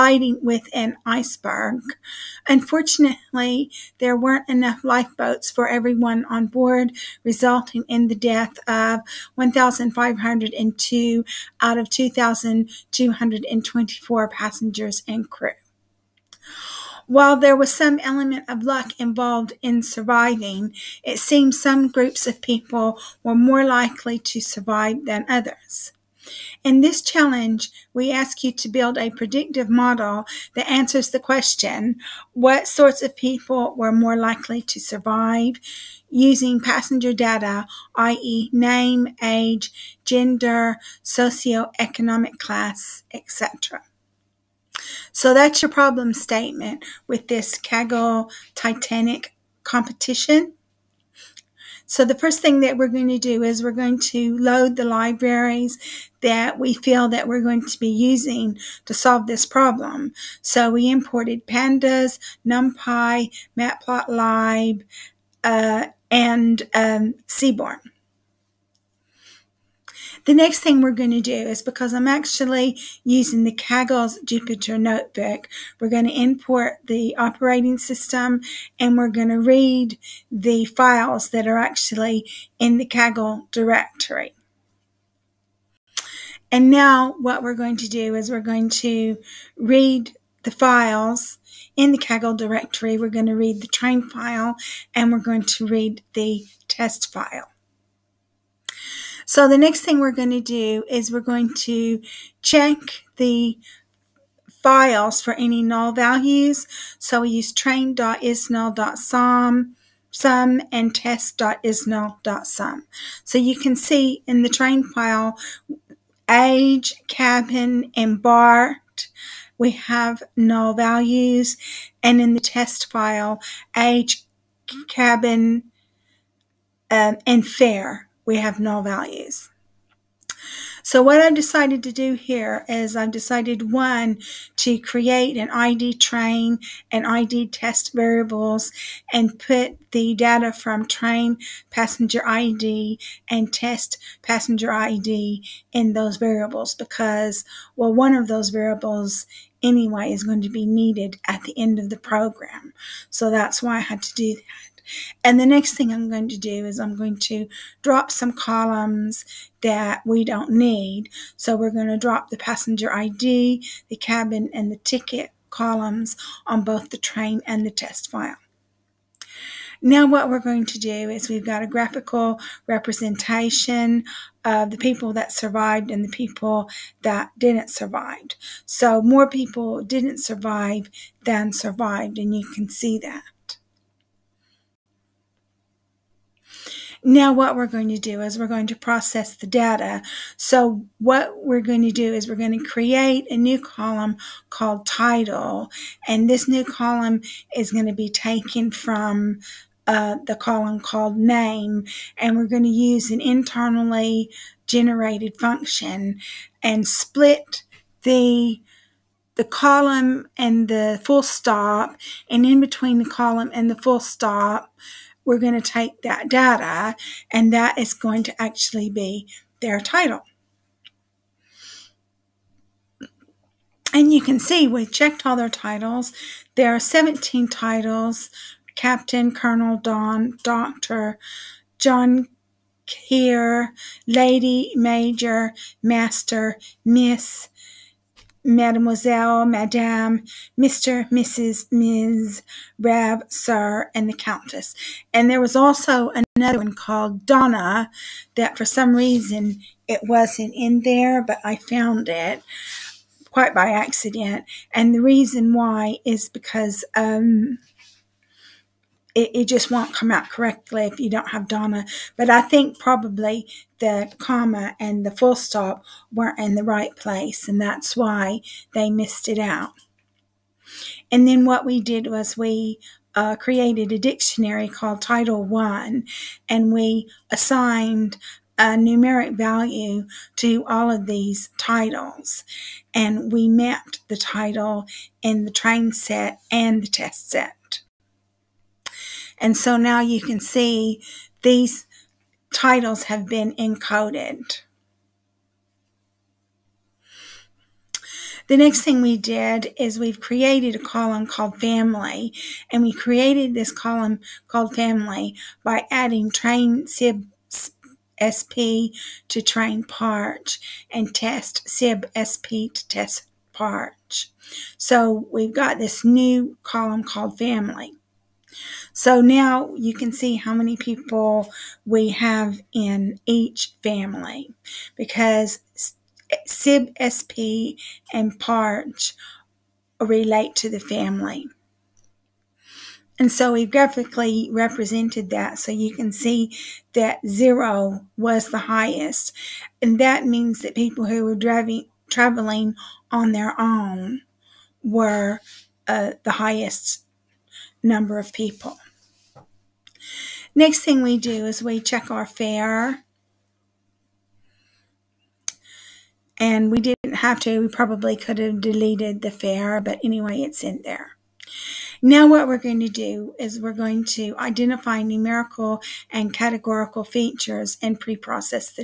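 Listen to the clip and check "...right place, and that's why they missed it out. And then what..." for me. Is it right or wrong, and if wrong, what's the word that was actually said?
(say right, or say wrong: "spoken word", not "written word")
right.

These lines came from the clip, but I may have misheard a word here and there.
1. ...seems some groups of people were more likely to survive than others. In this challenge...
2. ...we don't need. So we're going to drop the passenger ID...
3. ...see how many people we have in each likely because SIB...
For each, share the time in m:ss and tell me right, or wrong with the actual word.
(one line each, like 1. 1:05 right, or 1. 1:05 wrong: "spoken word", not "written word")
1. 0:21 right
2. 2:40 right
3. 5:20 wrong: "family", not "likely".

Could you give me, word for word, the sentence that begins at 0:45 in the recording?
So that's your problem statement with this Kaggle Titanic competition.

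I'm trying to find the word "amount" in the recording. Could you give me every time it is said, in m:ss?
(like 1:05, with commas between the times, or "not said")
not said.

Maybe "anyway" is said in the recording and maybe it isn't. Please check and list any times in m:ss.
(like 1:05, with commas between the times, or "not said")
2:29, 6:00.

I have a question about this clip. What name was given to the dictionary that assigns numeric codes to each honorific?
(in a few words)
Title One.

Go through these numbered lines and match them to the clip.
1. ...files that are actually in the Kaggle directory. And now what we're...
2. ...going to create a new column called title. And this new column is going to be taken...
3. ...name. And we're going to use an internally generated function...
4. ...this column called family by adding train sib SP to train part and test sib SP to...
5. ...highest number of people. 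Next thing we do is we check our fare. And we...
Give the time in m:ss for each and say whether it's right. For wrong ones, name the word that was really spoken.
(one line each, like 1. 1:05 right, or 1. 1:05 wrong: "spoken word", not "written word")
1. 1:20 right
2. 3:12 right
3. 3:21 right
4. 5:03 right
5. 5:46 right.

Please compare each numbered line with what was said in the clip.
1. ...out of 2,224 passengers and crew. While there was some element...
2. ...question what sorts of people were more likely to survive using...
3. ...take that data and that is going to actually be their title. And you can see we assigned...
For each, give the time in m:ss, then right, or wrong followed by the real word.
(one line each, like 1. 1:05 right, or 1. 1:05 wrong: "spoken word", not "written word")
1. 0:11 right
2. 0:31 right
3. 3:35 wrong: "checked", not "assigned".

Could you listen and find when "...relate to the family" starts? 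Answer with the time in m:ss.
5:29.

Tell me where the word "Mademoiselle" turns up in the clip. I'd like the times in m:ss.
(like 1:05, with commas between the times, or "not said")
3:58.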